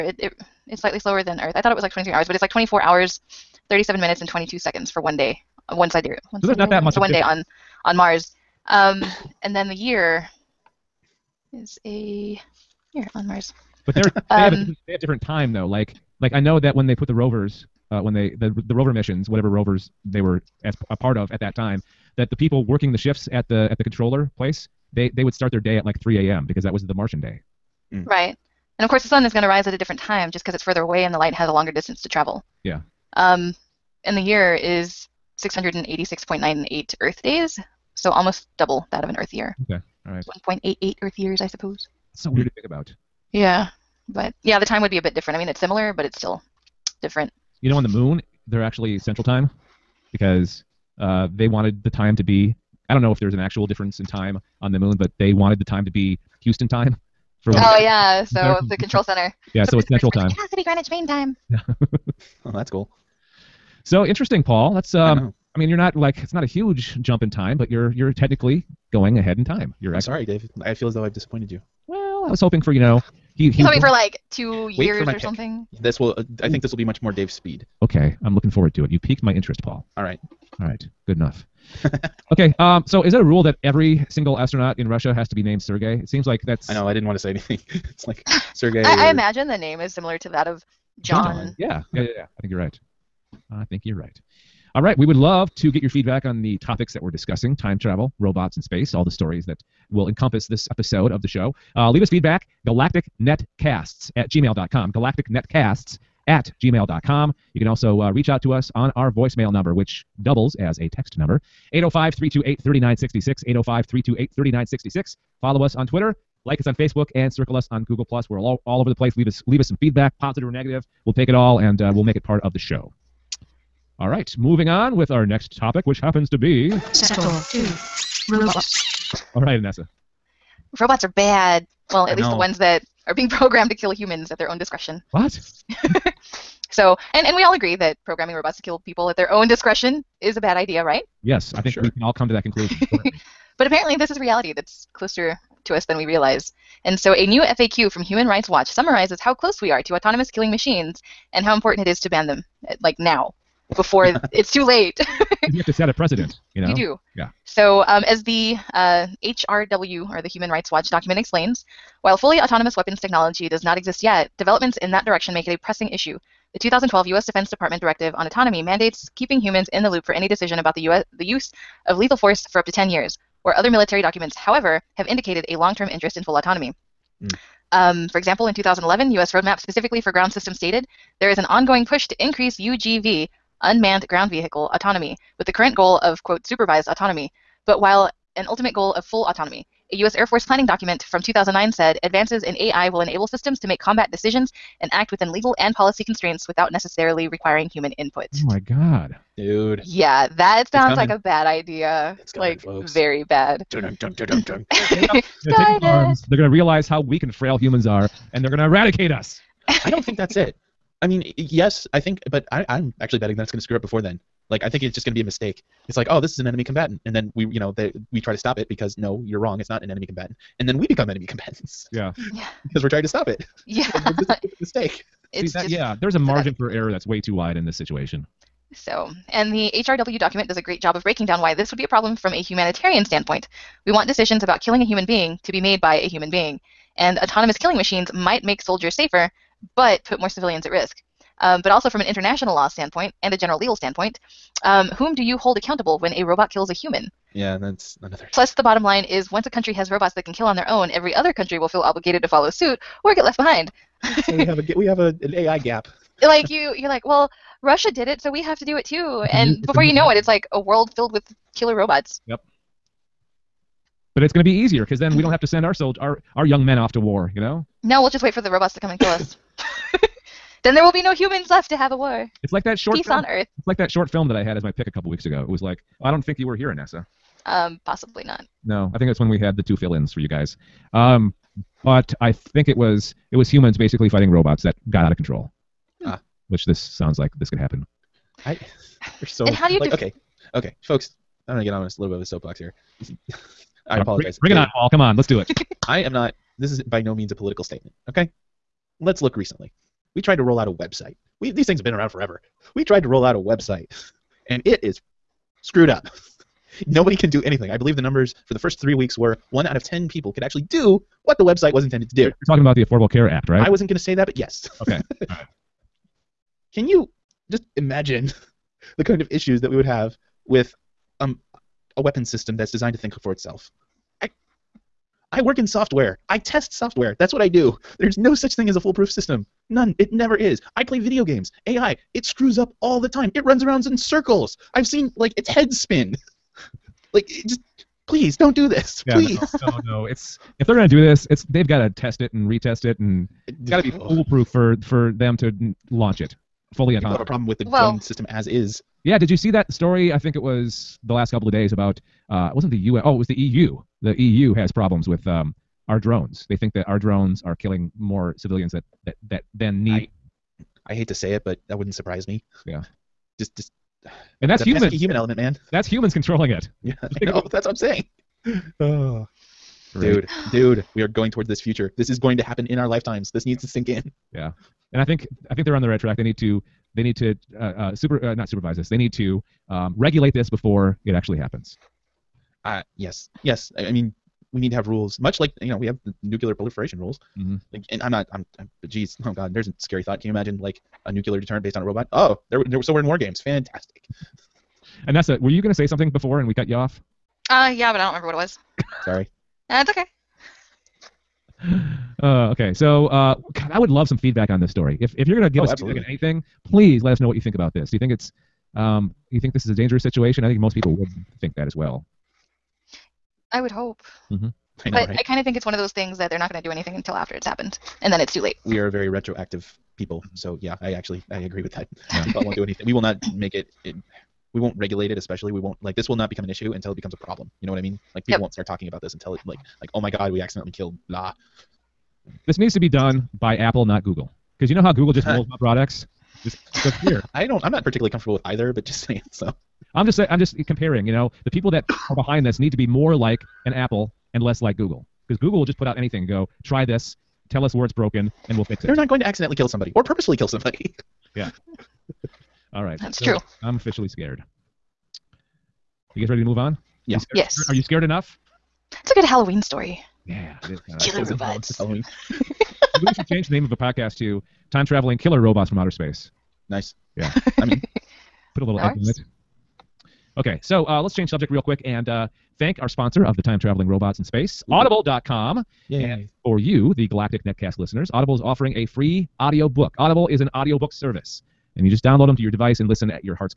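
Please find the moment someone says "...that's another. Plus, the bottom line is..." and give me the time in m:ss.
4:07.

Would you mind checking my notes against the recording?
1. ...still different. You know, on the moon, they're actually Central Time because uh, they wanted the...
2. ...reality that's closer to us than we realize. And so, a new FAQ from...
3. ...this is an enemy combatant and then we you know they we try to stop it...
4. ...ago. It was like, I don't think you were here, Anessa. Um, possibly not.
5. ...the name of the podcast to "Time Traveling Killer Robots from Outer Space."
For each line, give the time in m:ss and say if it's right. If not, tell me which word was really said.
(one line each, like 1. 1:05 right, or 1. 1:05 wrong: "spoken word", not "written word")
1. 0:46 right
2. 2:24 right
3. 3:36 right
4. 4:35 right
5. 7:43 right.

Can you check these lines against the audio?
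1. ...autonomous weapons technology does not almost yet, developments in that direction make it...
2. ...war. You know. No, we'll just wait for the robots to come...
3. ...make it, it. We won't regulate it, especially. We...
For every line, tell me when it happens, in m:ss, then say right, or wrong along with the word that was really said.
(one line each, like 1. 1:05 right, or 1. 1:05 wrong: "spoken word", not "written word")
1. 2:42 wrong: "exist", not "almost"
2. 4:26 right
3. 7:03 right.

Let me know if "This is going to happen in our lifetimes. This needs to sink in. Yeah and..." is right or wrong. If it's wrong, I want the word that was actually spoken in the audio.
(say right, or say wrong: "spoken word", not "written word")
right.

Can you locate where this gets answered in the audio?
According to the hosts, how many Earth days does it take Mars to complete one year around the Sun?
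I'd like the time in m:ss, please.
0:35.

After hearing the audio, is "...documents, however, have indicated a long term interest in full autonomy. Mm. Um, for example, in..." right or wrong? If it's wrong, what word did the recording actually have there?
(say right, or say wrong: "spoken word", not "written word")
right.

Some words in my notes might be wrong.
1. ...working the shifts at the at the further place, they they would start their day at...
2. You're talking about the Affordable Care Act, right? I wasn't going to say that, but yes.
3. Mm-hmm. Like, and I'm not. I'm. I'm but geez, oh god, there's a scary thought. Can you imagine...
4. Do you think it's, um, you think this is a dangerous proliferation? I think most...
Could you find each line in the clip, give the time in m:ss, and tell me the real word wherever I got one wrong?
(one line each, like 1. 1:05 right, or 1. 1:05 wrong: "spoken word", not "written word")
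1. 0:22 wrong: "controller", not "further"
2. 5:12 right
3. 6:27 right
4. 6:47 wrong: "situation", not "proliferation".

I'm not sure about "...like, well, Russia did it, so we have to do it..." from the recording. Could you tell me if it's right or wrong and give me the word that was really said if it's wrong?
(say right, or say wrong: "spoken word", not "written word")
right.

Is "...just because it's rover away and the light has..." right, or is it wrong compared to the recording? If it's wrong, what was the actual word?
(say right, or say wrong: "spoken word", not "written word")
wrong: "further", not "rover".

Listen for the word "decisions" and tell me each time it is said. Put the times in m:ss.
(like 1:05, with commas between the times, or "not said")
2:50, 3:14, 3:54.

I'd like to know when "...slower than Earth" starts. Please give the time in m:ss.
0:00.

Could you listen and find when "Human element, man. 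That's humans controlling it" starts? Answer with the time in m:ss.
6:04.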